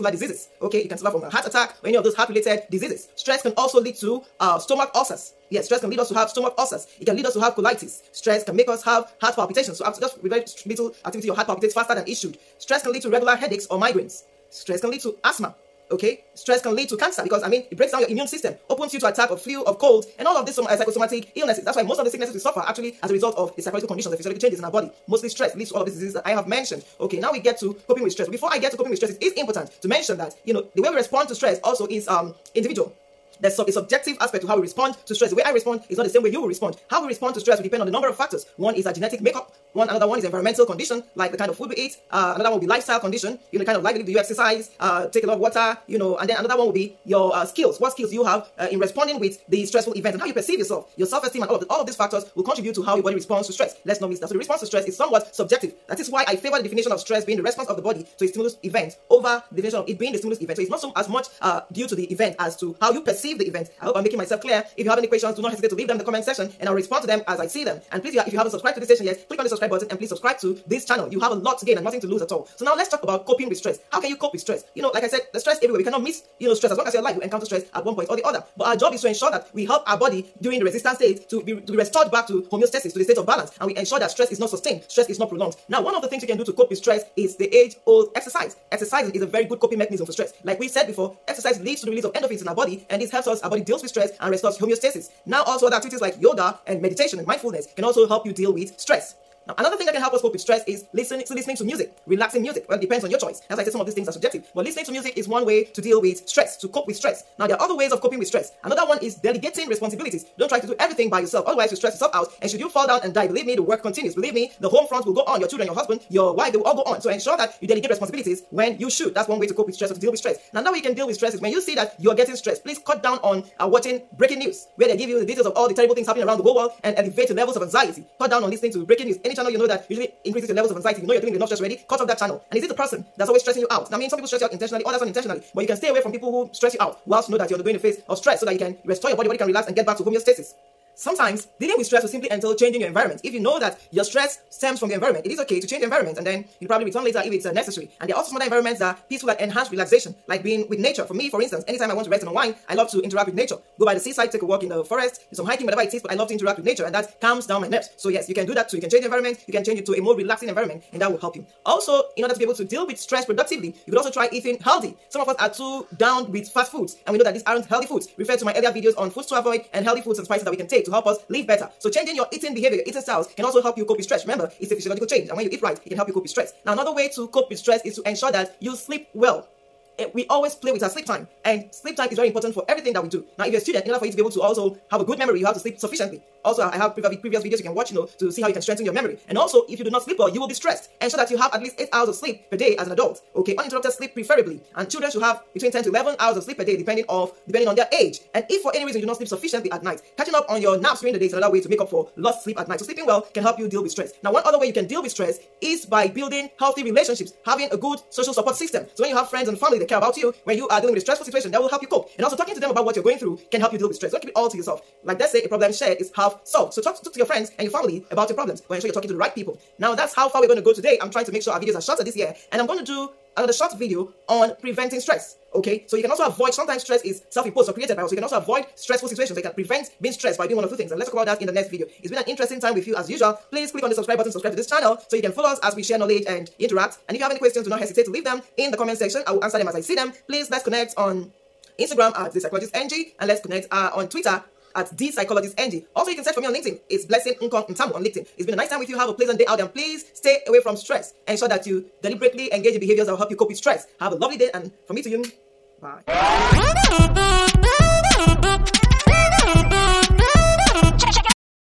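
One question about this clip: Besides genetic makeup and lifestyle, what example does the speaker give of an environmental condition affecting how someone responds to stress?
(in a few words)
the kind of food we eat.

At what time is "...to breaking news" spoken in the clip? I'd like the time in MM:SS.
02:08.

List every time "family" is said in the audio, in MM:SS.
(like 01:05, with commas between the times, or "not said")
03:29, 03:37.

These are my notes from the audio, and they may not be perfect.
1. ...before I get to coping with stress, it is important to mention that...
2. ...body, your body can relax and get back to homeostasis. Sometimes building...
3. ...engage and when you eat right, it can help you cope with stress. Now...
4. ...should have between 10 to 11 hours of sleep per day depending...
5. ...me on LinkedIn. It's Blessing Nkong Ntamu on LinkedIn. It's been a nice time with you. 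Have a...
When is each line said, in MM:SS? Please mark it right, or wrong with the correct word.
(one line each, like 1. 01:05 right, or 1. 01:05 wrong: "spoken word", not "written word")
1. 00:28 right
2. 02:19 wrong: "dealing", not "building"
3. 02:55 wrong: "change", not "engage"
4. 03:15 right
5. 04:06 right.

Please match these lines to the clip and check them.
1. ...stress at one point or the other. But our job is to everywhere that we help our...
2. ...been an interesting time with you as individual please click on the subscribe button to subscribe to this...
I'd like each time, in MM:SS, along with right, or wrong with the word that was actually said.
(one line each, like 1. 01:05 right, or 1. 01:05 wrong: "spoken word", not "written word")
1. 01:17 wrong: "ensure", not "everywhere"
2. 03:52 wrong: "usual", not "individual".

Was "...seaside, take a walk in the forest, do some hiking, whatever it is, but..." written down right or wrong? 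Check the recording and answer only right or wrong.
right.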